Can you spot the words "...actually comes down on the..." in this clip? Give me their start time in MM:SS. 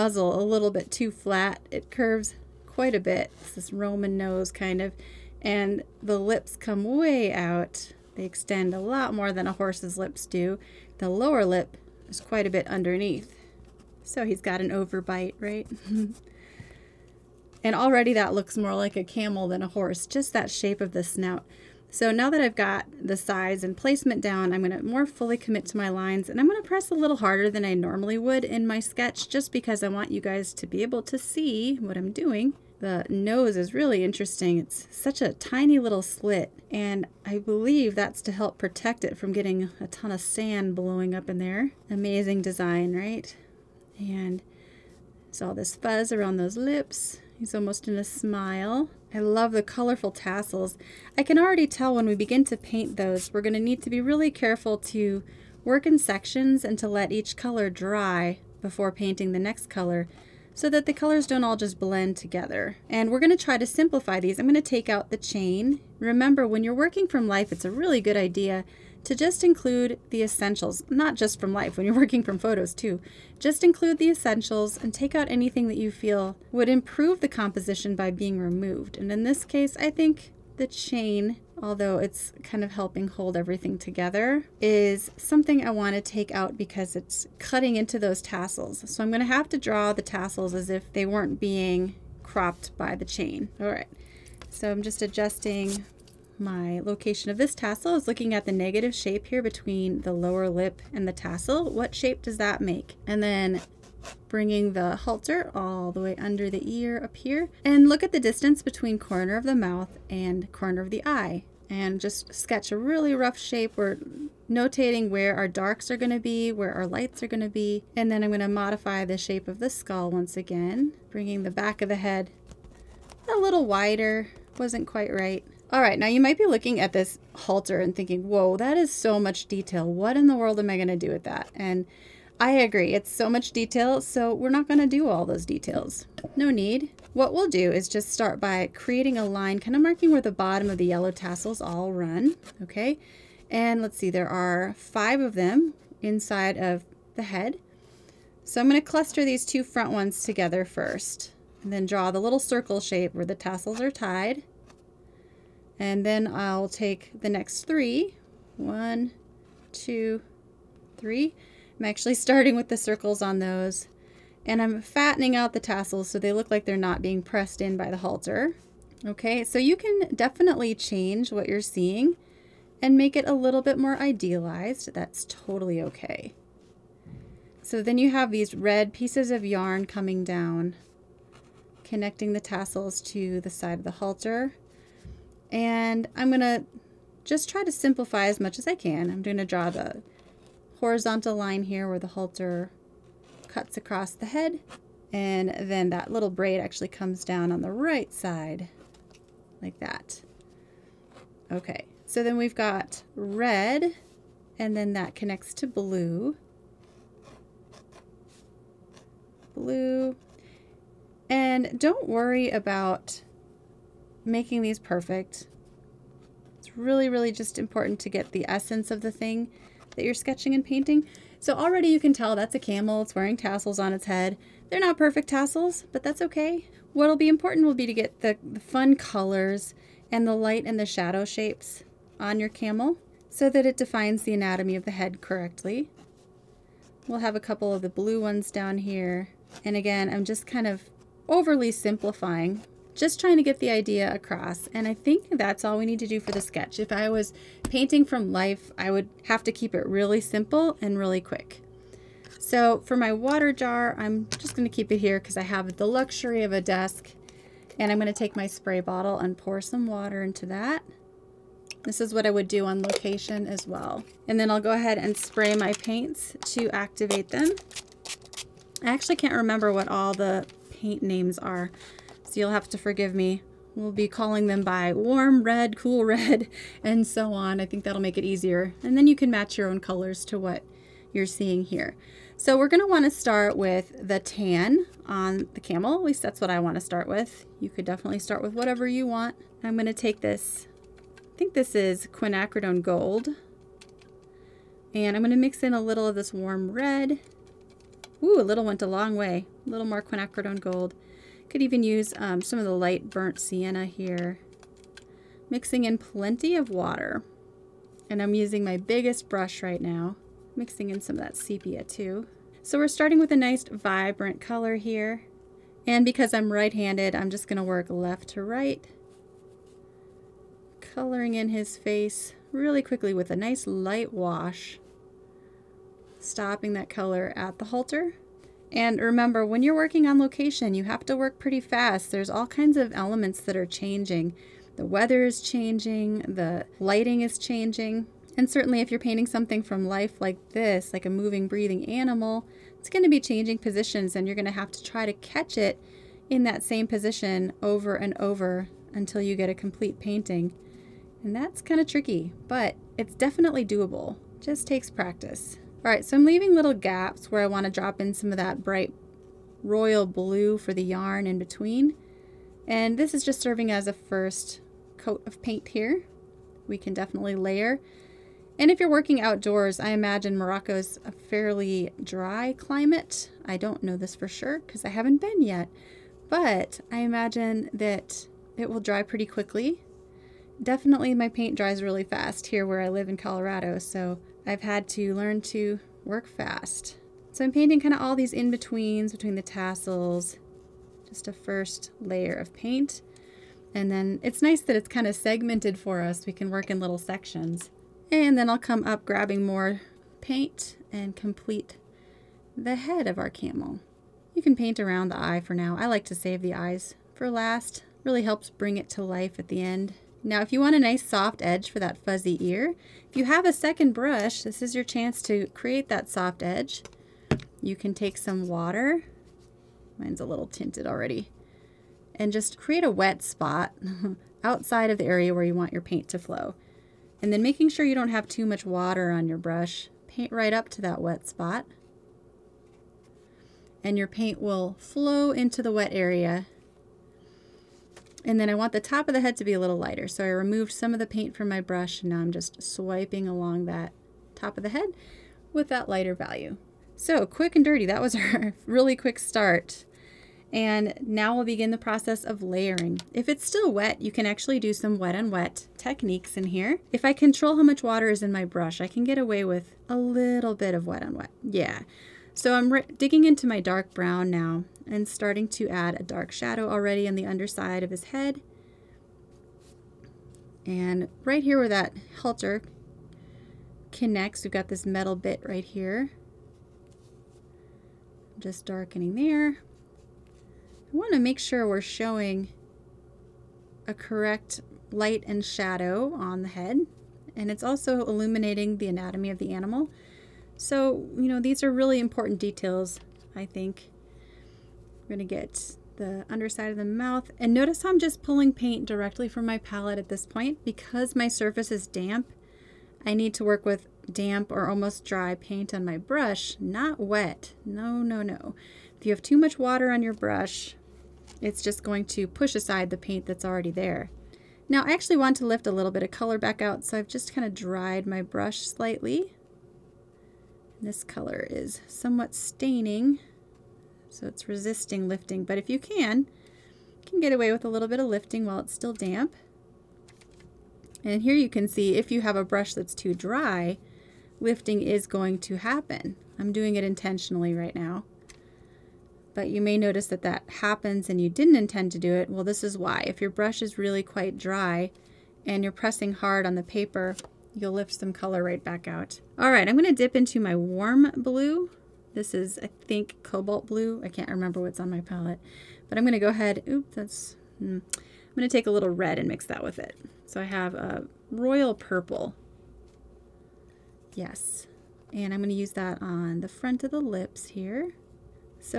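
03:16.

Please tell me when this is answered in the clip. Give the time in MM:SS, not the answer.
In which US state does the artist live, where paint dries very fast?
06:23.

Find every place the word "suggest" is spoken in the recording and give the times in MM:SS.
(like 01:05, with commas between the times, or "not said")
not said.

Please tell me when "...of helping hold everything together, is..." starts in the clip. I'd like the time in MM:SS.
01:22.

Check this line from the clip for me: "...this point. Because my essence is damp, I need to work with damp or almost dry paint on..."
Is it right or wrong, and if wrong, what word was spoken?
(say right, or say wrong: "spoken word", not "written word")
wrong: "surface", not "essence".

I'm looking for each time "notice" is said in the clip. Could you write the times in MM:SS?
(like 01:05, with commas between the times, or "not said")
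08:17, 08:59.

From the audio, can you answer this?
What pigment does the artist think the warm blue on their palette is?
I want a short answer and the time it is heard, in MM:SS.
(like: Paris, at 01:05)
Cobalt blue, at 09:13.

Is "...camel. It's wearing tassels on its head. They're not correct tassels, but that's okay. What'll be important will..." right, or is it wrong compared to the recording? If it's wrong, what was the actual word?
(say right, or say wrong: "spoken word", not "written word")
wrong: "perfect", not "correct".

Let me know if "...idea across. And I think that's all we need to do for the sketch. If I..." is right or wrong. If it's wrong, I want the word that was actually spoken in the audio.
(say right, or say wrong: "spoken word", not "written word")
right.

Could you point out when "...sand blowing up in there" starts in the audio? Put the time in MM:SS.
00:40.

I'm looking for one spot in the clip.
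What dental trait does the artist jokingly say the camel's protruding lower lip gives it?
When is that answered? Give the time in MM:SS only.
00:14.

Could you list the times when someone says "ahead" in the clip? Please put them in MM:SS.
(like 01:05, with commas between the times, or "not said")
04:24, 09:16.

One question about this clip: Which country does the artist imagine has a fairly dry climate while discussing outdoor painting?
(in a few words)
Morocco.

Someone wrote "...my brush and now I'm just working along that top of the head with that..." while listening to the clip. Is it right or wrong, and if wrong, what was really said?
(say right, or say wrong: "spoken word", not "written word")
wrong: "swiping", not "working".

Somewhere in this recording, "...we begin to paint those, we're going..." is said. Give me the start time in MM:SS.
00:52.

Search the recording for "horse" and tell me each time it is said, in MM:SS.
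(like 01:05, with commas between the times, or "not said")
00:09, 00:19.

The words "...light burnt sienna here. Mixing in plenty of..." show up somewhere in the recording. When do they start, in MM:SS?
05:02.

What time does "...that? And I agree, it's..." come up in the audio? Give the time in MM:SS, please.
02:11.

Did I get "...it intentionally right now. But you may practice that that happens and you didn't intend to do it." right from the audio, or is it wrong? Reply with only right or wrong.
wrong.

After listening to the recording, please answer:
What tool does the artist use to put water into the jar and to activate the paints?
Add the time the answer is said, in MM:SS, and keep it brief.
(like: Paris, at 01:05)
Spray bottle, at 04:18.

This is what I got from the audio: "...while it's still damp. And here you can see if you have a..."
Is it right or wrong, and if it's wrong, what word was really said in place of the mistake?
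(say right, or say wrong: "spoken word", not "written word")
right.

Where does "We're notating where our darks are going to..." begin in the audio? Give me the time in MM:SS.
01:53.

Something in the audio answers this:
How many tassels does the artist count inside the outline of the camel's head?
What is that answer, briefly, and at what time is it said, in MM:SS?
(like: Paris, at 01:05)
5, at 02:24.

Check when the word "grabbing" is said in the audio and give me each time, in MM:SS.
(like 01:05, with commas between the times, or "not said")
06:39.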